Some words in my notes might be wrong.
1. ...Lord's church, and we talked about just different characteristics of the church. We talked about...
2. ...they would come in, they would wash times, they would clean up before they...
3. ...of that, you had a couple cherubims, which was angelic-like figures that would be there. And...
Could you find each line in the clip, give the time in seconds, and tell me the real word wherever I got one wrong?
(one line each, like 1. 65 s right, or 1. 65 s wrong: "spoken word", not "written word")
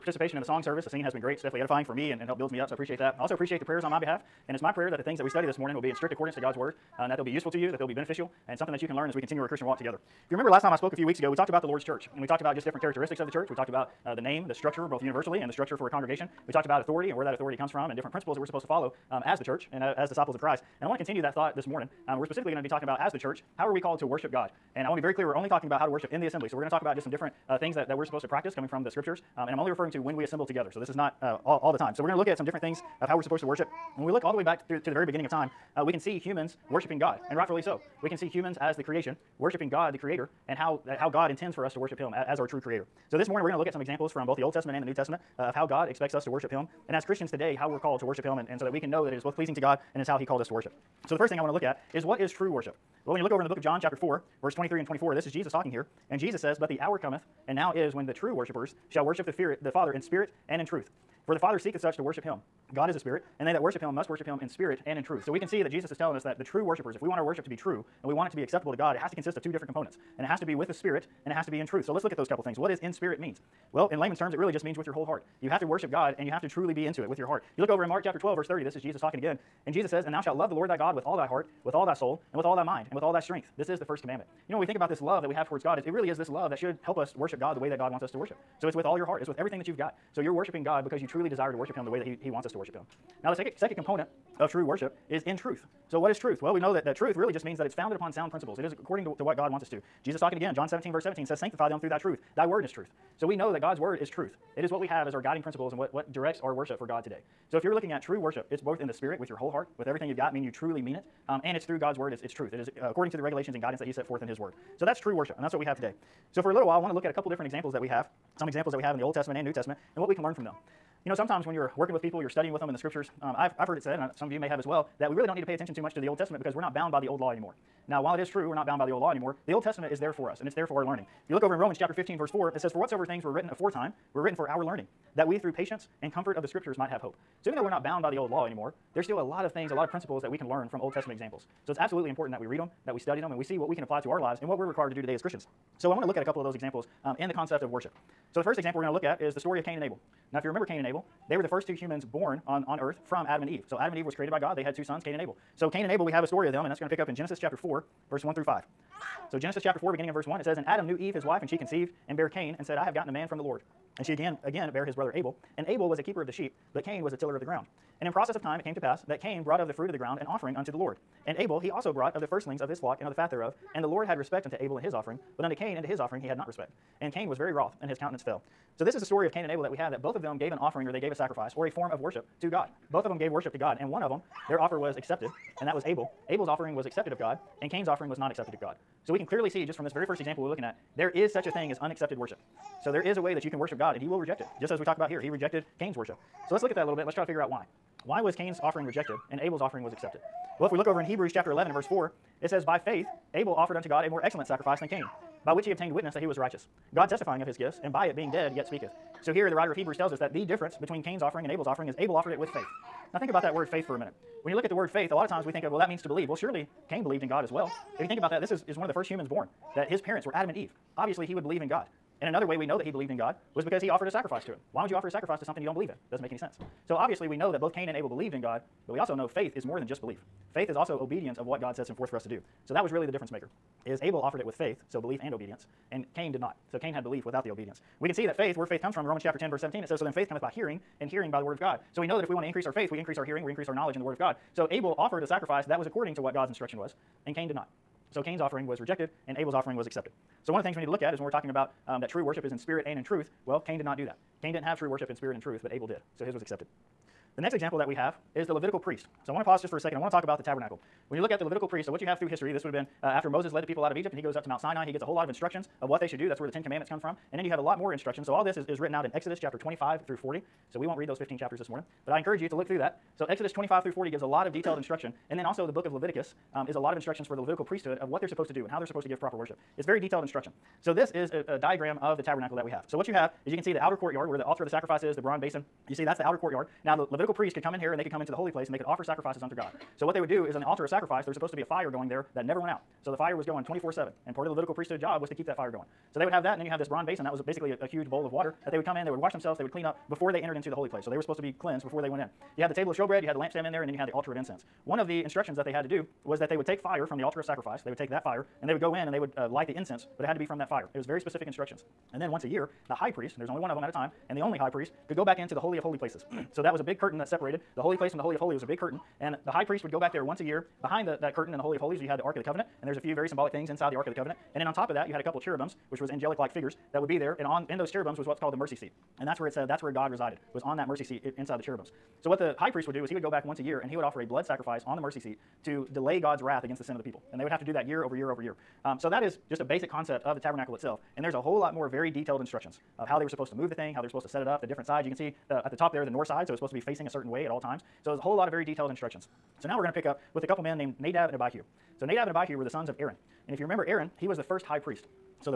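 1. 11 s right
2. 298 s wrong: "themselves", not "times"
3. 324 s right.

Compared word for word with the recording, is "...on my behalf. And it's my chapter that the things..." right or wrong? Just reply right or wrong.
wrong.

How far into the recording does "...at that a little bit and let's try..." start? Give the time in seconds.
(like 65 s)
196 s.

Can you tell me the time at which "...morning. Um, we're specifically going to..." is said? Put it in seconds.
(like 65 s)
21 s.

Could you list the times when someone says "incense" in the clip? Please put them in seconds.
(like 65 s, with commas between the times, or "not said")
304 s, 309 s.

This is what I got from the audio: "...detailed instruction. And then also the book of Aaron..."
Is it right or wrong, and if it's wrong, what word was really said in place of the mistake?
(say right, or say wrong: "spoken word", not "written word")
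wrong: "Leviticus", not "Aaron".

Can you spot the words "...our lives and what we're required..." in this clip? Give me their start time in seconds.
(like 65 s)
144 s.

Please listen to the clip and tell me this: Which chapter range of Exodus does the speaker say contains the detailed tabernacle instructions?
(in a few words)
Exodus 25 through 40.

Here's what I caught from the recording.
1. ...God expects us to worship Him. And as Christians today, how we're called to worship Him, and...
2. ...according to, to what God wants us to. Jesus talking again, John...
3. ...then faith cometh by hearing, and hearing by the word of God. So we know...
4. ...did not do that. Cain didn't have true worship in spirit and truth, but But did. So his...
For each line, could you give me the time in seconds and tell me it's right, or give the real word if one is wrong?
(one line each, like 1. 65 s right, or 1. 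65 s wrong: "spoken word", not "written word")
1. 45 s right
2. 98 s right
3. 240 s right
4. 253 s wrong: "Abel", not "But".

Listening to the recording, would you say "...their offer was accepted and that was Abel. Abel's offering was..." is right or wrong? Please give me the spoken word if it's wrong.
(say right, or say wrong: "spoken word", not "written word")
right.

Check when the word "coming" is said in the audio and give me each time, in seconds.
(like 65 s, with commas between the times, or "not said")
28 s.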